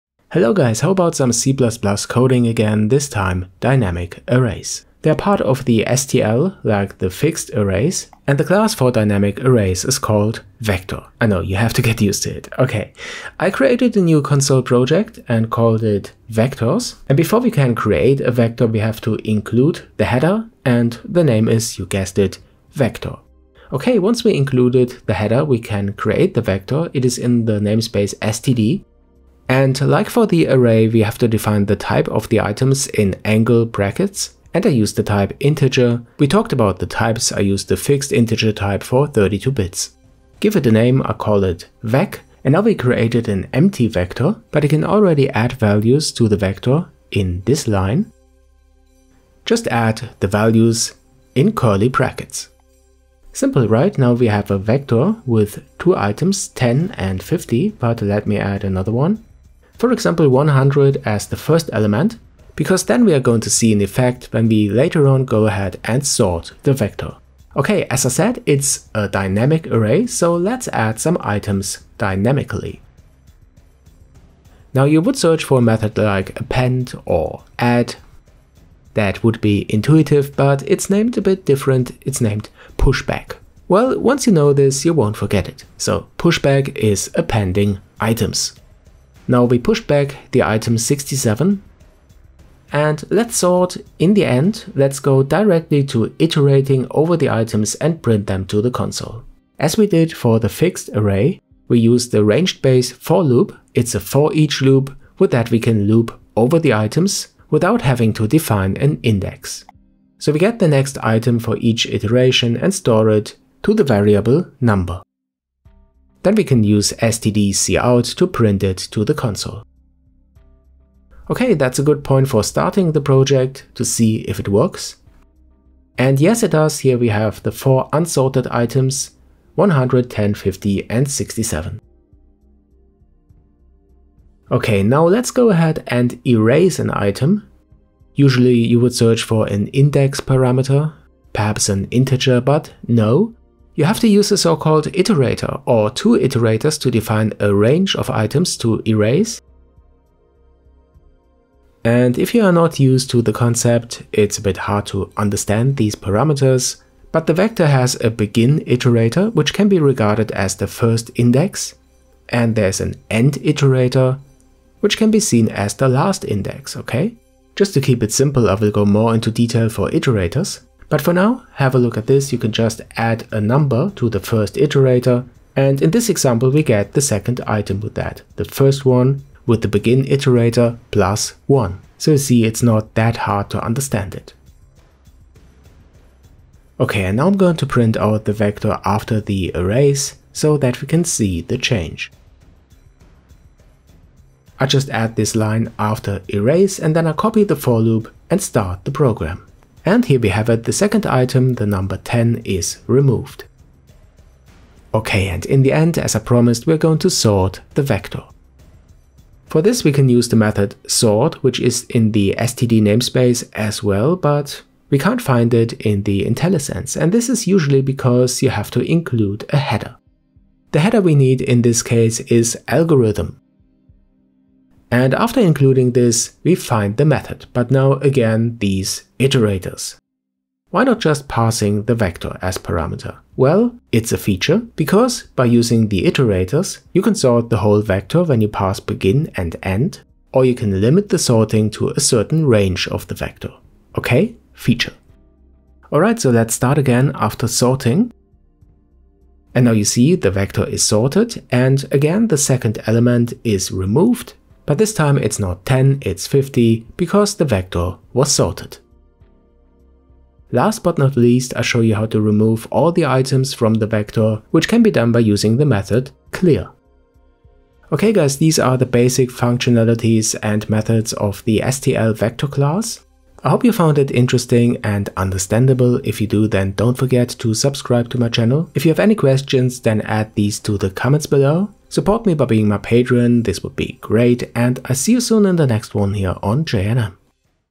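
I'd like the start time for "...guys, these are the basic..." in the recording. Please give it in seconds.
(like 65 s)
268 s.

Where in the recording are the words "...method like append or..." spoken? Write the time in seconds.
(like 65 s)
75 s.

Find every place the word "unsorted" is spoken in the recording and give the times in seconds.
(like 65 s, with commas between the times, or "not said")
127 s.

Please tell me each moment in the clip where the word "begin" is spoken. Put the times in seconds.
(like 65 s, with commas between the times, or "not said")
158 s, 179 s, 238 s.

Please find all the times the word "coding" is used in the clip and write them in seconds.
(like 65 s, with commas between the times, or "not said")
1 s.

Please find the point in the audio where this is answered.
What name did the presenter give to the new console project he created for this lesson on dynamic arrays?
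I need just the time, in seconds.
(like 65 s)
16 s.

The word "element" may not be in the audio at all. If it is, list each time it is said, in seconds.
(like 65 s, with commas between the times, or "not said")
61 s, 252 s.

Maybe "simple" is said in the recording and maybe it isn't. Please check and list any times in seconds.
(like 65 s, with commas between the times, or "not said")
53 s, 168 s.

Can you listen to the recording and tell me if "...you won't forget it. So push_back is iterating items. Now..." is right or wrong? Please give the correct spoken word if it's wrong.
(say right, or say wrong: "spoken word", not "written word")
wrong: "appending", not "iterating".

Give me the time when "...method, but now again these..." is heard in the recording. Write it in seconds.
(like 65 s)
227 s.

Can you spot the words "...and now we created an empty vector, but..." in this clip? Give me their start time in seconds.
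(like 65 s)
42 s.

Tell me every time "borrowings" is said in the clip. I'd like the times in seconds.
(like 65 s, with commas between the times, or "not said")
not said.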